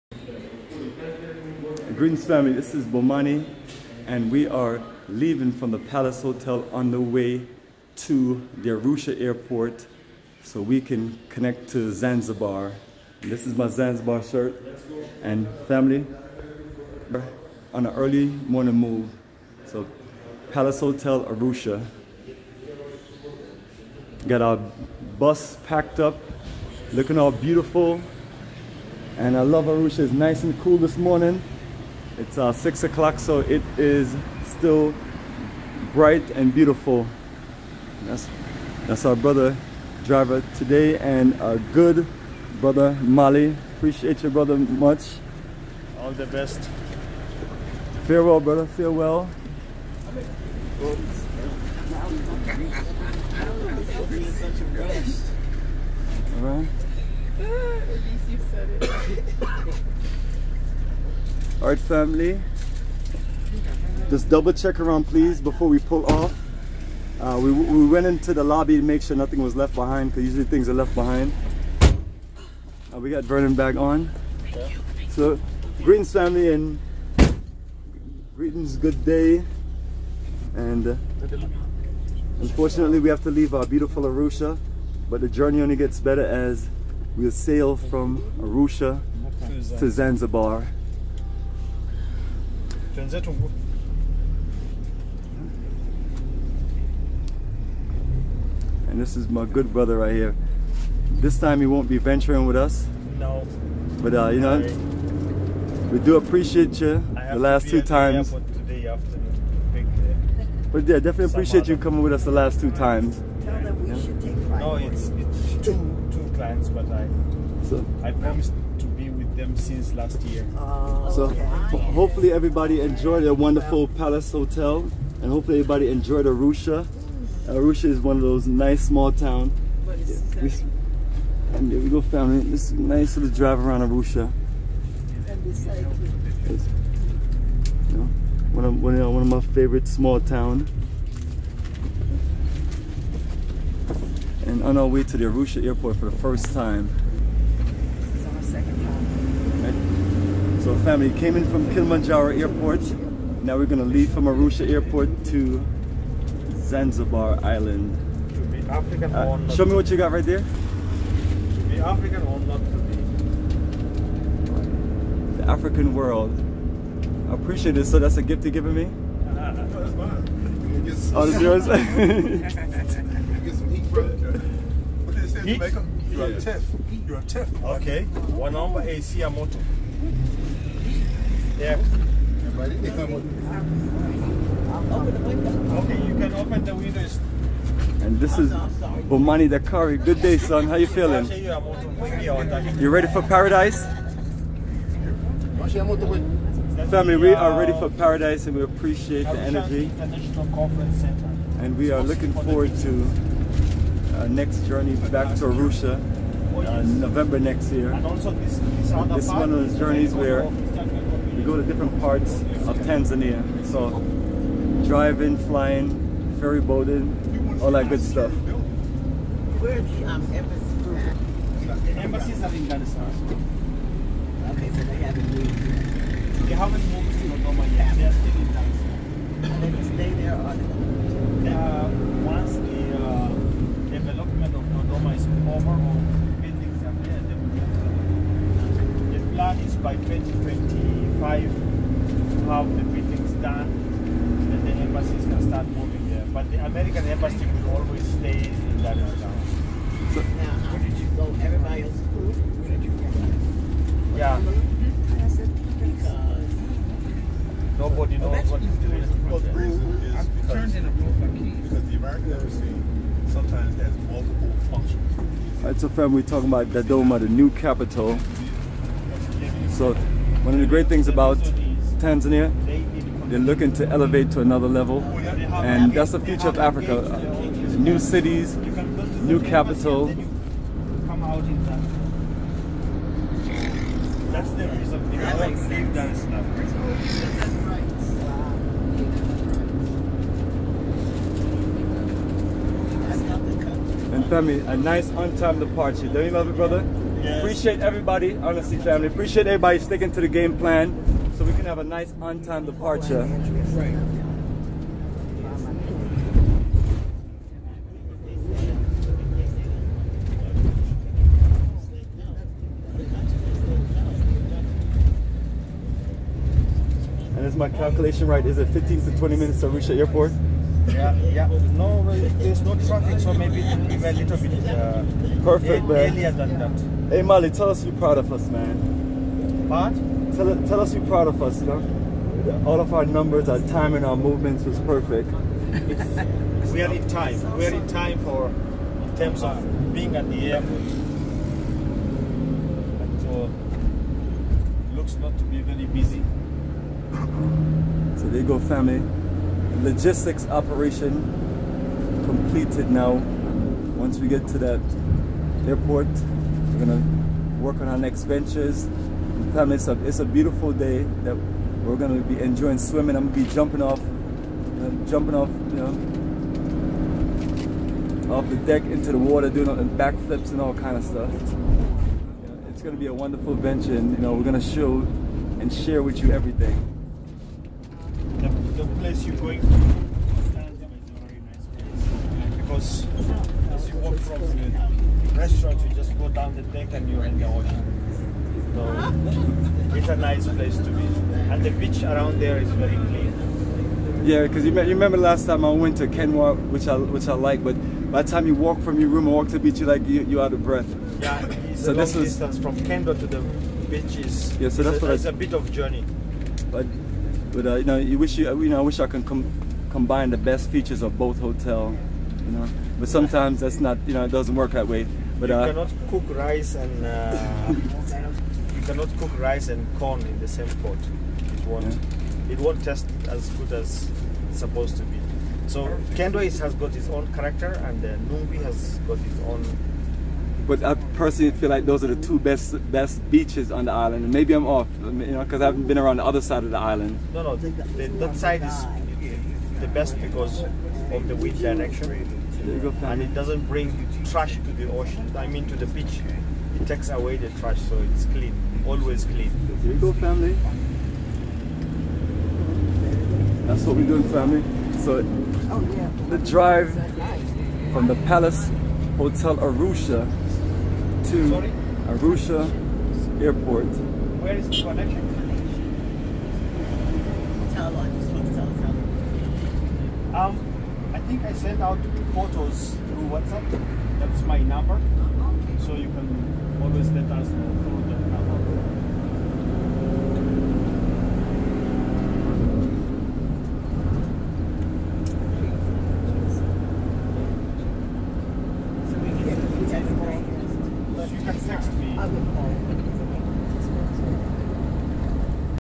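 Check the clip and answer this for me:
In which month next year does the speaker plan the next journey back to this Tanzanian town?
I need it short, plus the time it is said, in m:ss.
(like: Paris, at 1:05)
November, at 3:27.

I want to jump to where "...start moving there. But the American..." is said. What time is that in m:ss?
4:05.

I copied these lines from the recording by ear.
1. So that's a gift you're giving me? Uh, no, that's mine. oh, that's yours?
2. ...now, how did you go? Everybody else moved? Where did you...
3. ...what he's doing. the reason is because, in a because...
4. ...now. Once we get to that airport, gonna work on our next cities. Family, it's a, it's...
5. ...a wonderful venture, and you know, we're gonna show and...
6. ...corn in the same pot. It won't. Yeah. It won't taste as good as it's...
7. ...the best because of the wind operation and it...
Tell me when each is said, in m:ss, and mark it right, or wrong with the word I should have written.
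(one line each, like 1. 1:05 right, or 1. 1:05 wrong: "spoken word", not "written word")
1. 2:47 right
2. 4:10 right
3. 4:18 right
4. 5:52 wrong: "ventures", not "cities"
5. 6:13 right
6. 6:59 right
7. 7:19 wrong: "direction", not "operation".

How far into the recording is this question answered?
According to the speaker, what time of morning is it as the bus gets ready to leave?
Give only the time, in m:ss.
0:32.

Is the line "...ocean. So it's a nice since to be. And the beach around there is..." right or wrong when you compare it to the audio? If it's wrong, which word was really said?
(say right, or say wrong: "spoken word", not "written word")
wrong: "place", not "since".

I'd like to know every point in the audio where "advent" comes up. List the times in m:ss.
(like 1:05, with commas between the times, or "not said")
not said.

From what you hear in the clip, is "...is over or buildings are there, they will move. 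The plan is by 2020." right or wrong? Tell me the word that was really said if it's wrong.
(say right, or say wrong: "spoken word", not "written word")
right.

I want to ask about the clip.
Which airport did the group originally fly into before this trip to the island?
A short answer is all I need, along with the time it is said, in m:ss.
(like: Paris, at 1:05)
Kilimanjaro Airport, at 2:31.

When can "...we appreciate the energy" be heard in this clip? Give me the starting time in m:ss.
3:18.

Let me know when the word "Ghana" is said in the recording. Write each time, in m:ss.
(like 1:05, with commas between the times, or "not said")
3:42, 3:48.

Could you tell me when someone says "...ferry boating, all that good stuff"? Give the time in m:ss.
3:36.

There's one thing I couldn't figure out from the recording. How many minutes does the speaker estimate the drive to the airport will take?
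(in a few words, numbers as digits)
15 to 20 minutes.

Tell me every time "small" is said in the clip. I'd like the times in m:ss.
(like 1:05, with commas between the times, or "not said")
2:08, 2:19.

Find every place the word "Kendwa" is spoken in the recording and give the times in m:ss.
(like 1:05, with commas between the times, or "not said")
6:36, 6:42, 7:06.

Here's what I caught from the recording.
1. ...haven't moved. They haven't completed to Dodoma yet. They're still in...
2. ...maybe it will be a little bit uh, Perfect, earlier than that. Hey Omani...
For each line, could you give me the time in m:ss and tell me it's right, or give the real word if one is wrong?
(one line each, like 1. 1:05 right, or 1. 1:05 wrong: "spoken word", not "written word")
1. 3:45 wrong: "moved", not "completed"
2. 5:23 wrong: "Molly", not "Omani".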